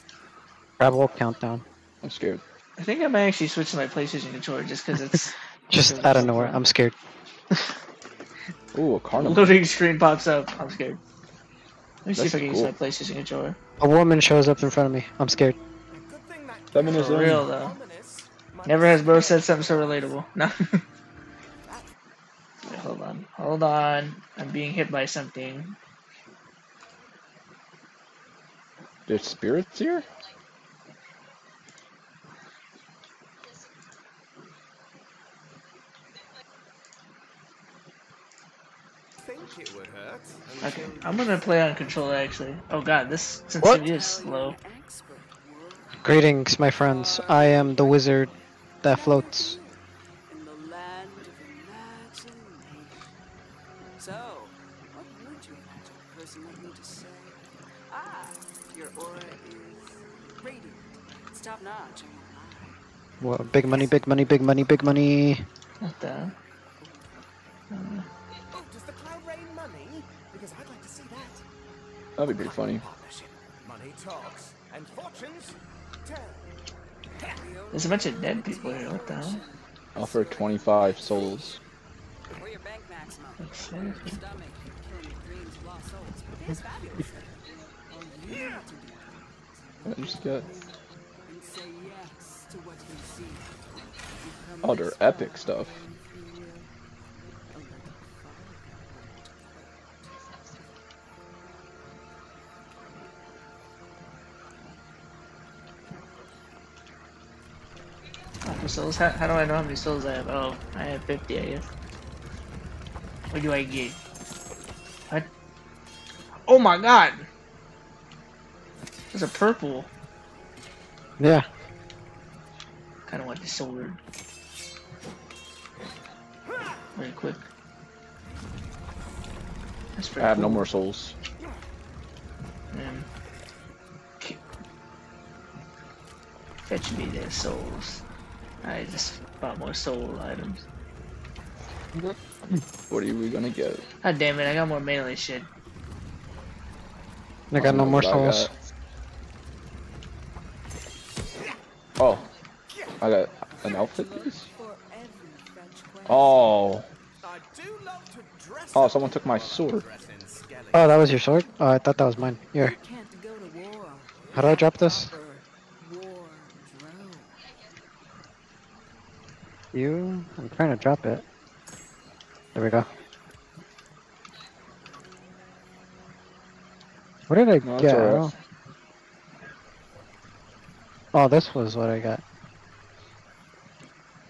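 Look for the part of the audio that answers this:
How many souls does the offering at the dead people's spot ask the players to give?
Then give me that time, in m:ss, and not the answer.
1:20.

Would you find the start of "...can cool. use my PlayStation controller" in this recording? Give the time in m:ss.
0:12.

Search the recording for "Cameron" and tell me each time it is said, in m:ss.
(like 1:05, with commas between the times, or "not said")
not said.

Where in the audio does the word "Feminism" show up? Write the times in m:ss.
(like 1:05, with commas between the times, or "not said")
0:16.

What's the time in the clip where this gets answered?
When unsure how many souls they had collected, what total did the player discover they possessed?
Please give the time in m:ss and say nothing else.
1:51.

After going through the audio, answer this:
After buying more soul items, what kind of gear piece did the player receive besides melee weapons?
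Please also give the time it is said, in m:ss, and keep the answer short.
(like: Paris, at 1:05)
outfit piece, at 2:33.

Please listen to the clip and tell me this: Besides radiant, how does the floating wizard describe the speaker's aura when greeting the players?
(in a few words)
top notch.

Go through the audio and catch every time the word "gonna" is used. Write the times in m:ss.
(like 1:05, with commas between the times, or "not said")
0:41, 2:23.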